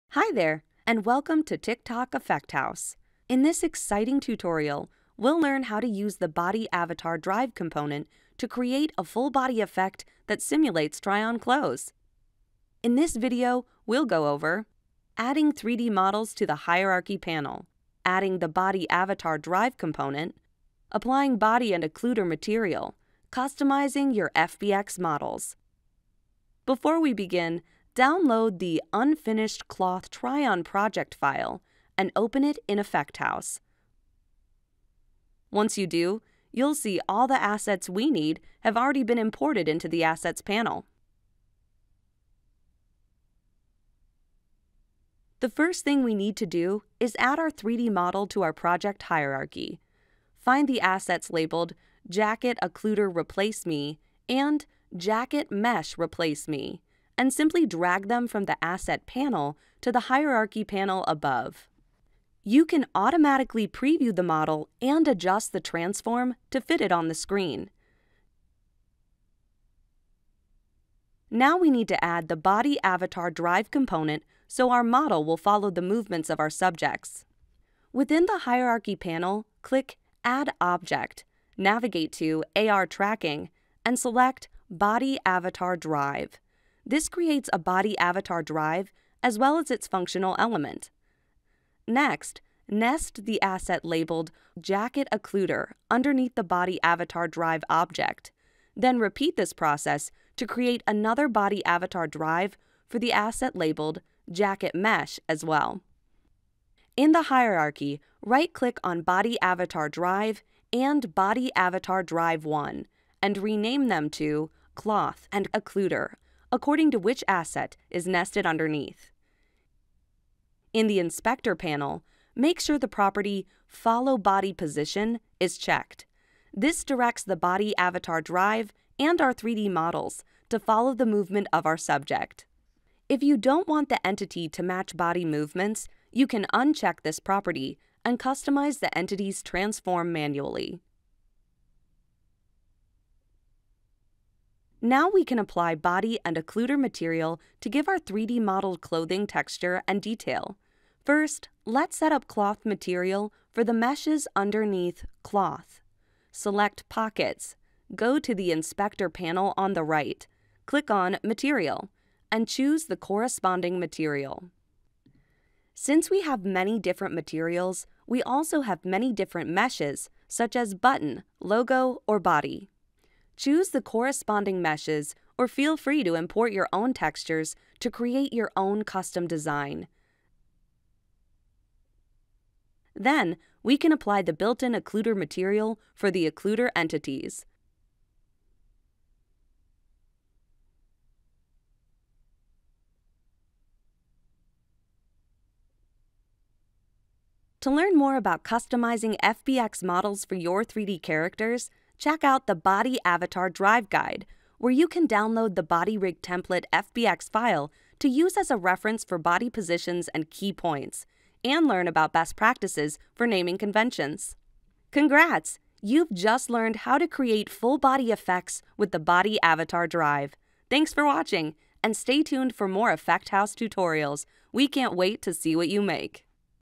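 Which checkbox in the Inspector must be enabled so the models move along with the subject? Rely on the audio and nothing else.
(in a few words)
Follow Body Position.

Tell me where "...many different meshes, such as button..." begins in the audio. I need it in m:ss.
2:48.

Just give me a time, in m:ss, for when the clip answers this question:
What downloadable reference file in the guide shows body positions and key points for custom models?
3:25.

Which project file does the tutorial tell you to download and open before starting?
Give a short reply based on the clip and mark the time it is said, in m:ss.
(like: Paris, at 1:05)
Unfinished Cloth Try-On, at 0:28.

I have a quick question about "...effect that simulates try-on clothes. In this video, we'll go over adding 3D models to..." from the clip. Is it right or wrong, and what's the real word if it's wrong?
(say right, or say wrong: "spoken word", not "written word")
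right.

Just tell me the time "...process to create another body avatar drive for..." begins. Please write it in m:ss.
1:39.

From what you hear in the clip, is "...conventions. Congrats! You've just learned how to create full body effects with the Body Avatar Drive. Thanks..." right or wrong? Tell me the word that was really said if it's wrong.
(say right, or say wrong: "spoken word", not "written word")
right.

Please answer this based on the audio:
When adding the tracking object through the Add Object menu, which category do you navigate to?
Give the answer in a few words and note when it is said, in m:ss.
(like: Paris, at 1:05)
AR Tracking, at 1:22.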